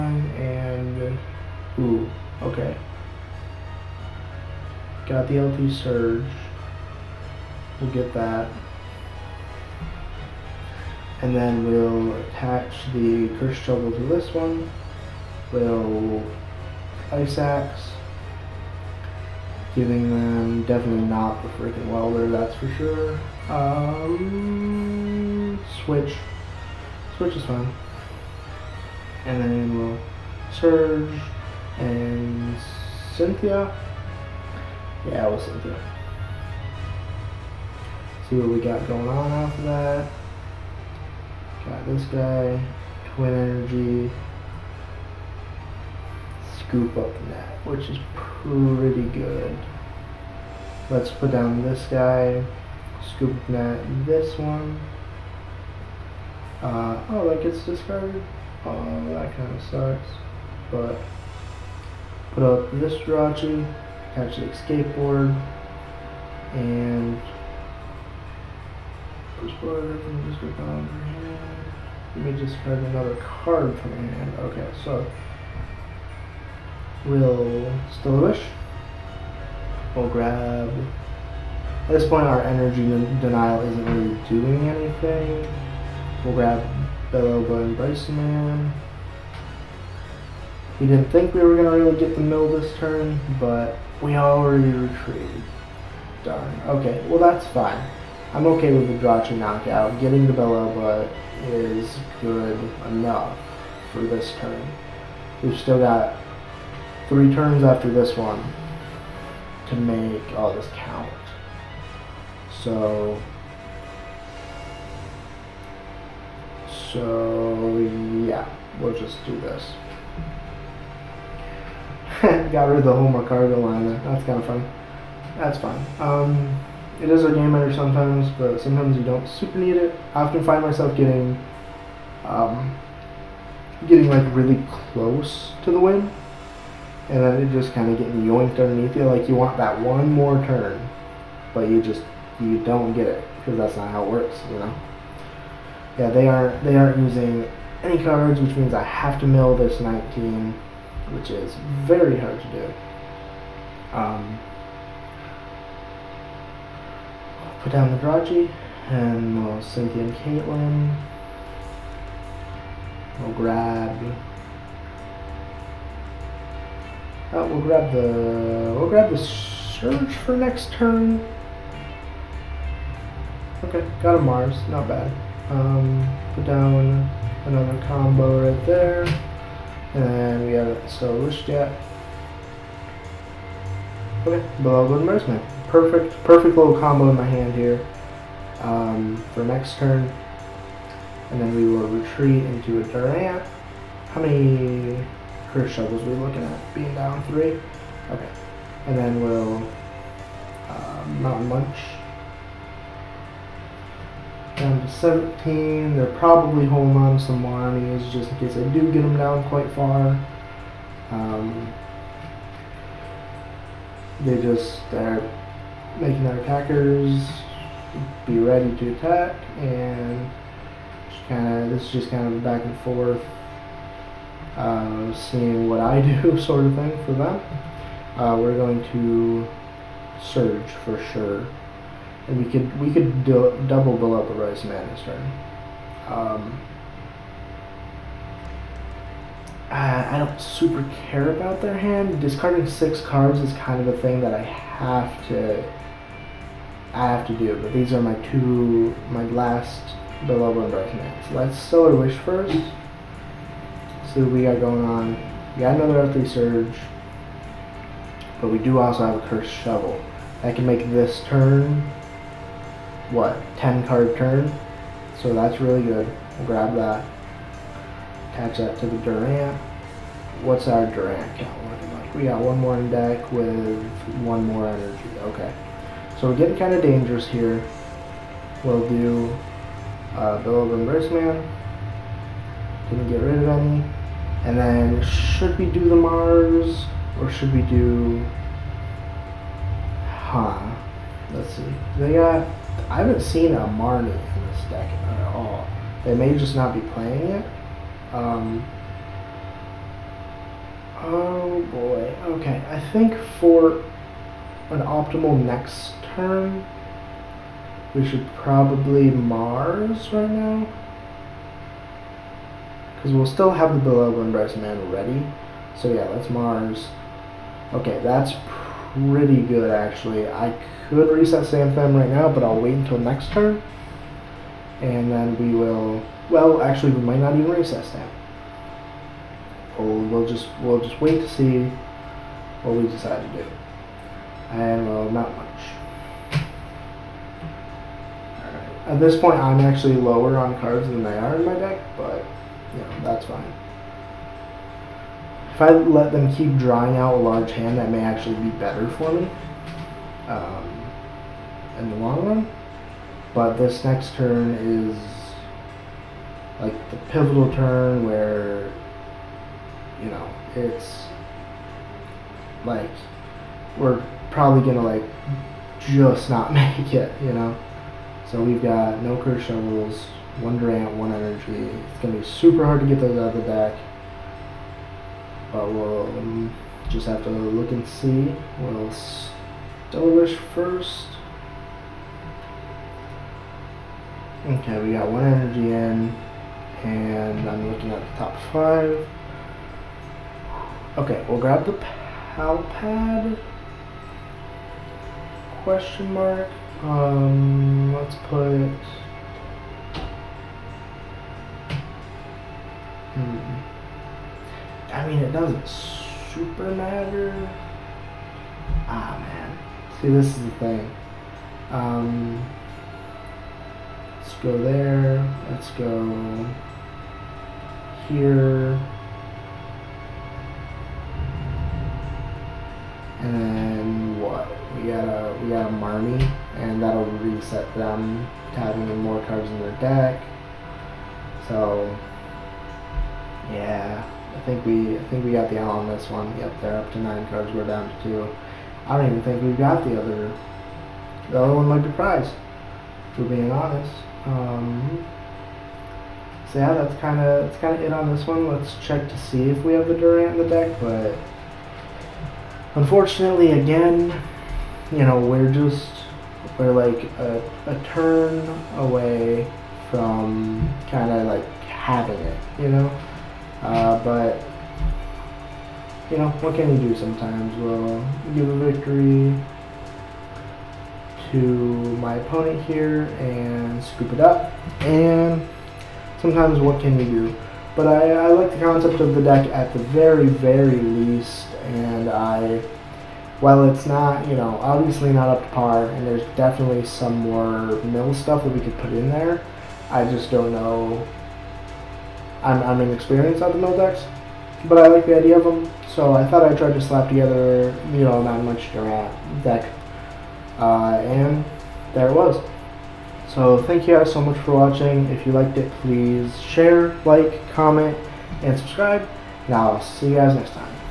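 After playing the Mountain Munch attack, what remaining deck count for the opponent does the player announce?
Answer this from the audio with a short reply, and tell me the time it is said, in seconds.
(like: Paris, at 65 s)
17, at 204 s.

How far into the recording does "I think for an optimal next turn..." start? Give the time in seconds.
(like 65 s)
302 s.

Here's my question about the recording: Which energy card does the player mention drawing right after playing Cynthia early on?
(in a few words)
Twin Energy.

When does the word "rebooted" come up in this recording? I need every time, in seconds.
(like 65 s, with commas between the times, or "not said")
not said.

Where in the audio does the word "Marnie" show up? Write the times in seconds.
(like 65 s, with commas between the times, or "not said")
293 s, 425 s.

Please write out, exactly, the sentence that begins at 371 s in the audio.
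It's going to be super hard to get those out of the deck.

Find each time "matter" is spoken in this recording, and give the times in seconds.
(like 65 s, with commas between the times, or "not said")
406 s.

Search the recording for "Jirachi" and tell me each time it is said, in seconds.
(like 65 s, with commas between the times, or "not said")
63 s, 99 s.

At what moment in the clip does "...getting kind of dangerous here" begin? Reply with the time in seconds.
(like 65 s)
276 s.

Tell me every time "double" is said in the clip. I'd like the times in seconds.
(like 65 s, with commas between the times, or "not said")
233 s.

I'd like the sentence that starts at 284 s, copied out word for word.
And then should we do the Mars or should we do...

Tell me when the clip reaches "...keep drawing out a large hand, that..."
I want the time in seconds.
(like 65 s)
346 s.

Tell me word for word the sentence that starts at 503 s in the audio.
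So thank you guys so much for watching.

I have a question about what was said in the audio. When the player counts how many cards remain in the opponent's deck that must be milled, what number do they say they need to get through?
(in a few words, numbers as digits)
19.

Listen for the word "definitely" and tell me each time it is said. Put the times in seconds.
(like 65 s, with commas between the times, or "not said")
20 s, 486 s.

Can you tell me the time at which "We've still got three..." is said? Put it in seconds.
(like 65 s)
105 s.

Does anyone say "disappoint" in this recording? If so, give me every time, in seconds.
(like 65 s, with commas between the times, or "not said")
not said.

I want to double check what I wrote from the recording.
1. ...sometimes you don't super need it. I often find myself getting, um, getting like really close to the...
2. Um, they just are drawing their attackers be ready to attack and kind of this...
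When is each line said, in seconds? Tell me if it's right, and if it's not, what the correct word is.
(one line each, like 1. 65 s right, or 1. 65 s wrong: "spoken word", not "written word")
1. 128 s right
2. 211 s wrong: "making", not "drawing".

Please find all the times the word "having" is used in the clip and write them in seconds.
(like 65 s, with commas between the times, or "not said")
428 s, 461 s.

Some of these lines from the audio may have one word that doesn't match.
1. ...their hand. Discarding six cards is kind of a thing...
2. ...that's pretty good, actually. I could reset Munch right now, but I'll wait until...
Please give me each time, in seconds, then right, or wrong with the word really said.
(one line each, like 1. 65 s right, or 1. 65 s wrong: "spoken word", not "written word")
1. 241 s right
2. 318 s wrong: "Sandflam", not "Munch".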